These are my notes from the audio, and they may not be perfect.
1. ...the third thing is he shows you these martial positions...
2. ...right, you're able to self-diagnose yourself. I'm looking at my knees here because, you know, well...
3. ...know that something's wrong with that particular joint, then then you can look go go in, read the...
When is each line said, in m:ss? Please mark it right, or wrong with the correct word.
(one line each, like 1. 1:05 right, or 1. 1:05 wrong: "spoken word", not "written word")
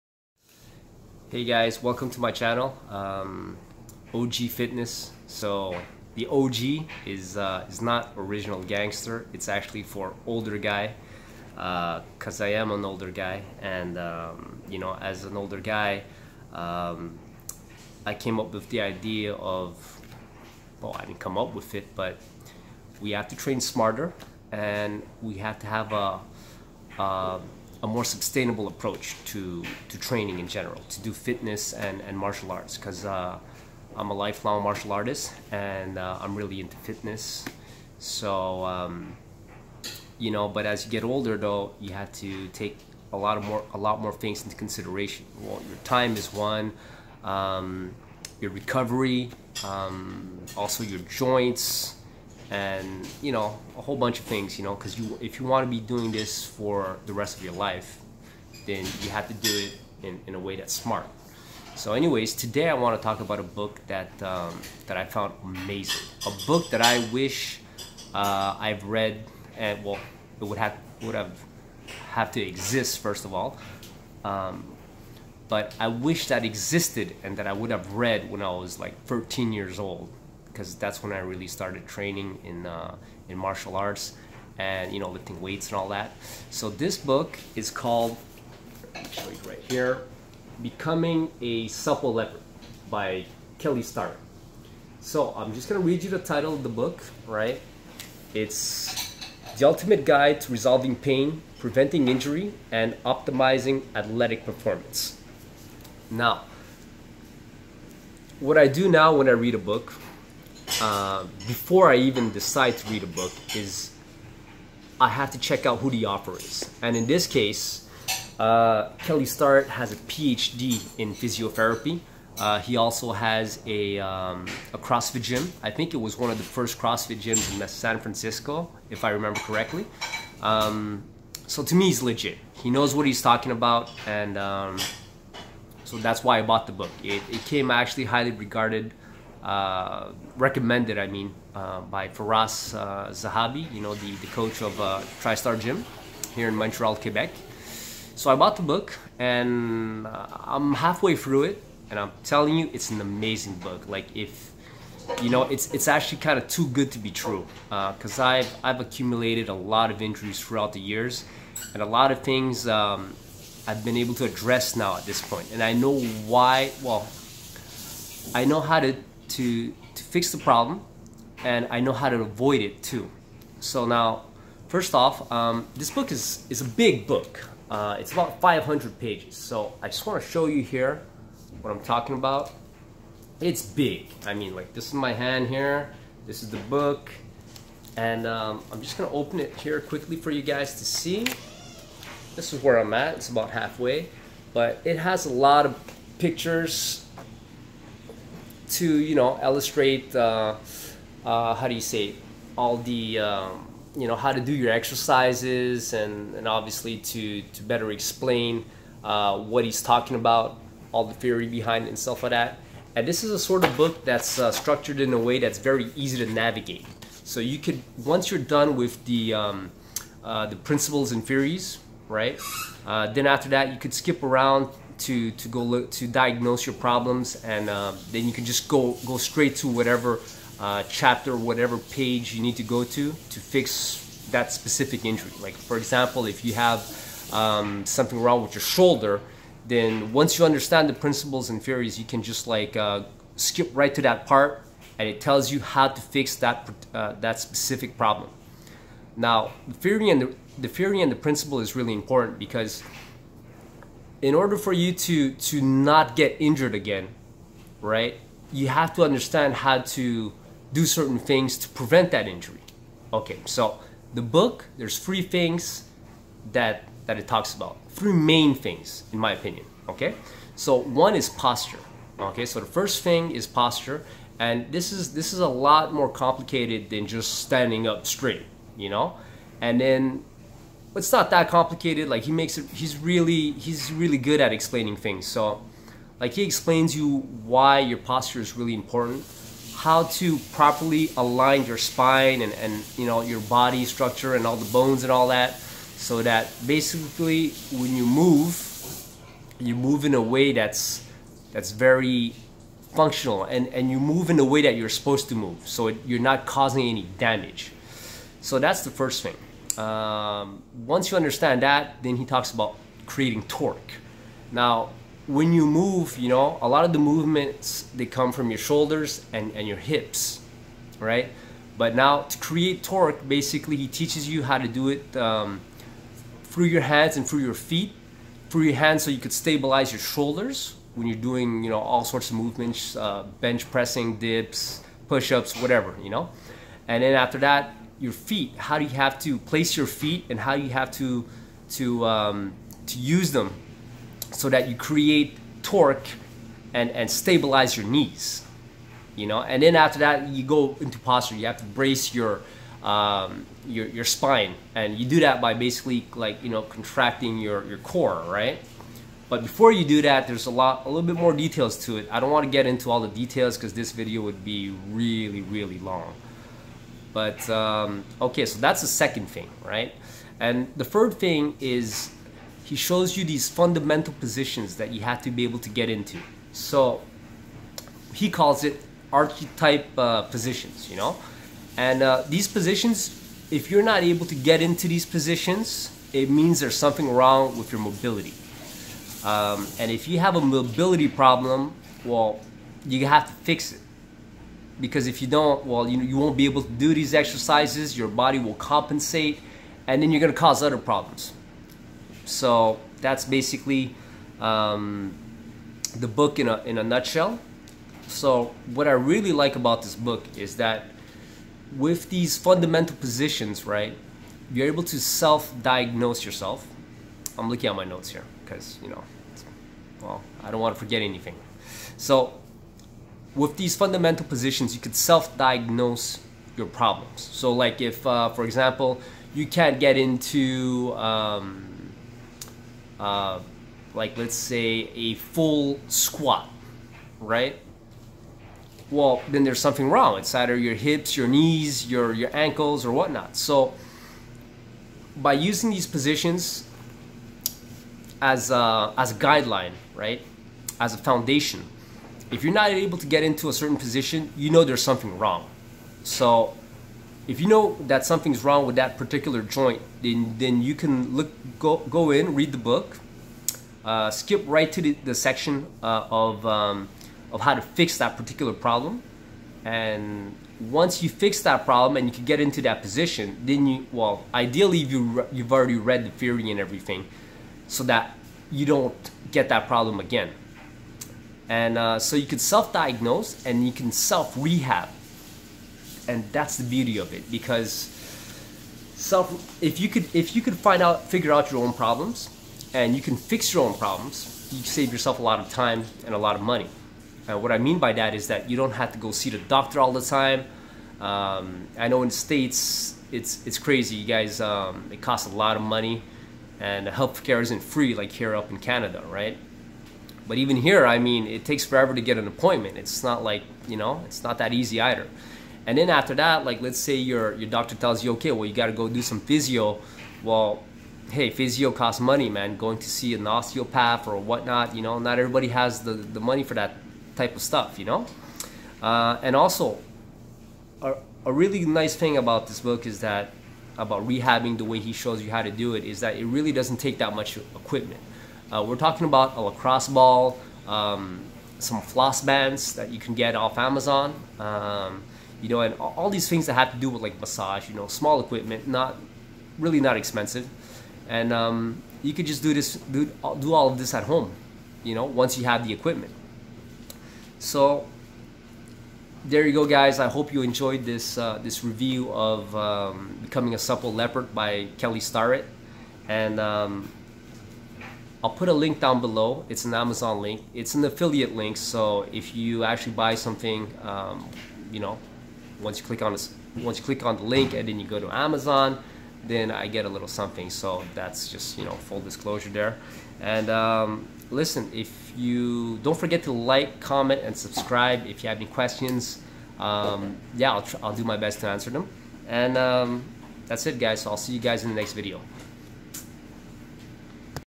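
1. 6:10 wrong: "fundamental", not "martial"
2. 6:53 wrong: "notes", not "knees"
3. 7:37 right.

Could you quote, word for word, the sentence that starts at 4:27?
Three main things in my opinion, okay?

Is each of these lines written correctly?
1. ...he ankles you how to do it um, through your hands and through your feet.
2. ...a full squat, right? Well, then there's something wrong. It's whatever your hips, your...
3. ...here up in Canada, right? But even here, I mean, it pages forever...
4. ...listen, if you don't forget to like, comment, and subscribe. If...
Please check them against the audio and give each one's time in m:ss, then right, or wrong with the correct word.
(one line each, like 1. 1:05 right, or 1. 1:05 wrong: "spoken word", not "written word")
1. 5:23 wrong: "teaches", not "ankles"
2. 7:14 wrong: "either", not "whatever"
3. 8:28 wrong: "takes", not "pages"
4. 9:44 right.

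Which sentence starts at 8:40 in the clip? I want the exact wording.
Well, hey, physio costs money, man.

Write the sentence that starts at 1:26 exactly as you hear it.
So this book is called right here, "Becoming a Supple Leopard" by Kelly Starrett.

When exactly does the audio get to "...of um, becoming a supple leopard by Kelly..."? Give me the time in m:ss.
9:22.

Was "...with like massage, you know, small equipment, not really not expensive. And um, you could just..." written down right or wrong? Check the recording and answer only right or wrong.
right.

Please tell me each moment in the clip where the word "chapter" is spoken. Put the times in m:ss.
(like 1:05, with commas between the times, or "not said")
3:50.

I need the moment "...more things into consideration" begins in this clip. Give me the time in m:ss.
0:43.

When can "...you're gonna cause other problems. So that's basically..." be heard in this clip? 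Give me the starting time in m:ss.
6:40.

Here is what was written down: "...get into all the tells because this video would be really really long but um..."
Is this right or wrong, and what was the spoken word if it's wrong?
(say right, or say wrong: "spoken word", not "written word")
wrong: "details", not "tells".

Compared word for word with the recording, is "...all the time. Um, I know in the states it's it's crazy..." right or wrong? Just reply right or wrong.
right.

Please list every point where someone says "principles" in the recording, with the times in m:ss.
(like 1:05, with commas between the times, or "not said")
3:40, 4:00, 4:11.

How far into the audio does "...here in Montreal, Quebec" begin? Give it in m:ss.
2:26.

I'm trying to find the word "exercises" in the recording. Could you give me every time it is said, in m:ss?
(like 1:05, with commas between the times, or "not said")
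3:24, 6:37.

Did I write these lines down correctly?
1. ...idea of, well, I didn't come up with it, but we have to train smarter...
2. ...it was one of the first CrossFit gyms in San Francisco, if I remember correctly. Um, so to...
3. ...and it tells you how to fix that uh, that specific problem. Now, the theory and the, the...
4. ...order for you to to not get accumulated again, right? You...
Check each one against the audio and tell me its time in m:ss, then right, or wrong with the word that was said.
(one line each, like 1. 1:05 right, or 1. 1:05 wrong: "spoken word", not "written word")
1. 0:18 right
2. 2:05 right
3. 4:04 right
4. 4:14 wrong: "injured", not "accumulated".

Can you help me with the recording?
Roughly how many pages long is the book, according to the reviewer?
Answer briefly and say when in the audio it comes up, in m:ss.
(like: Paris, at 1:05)
500, at 2:58.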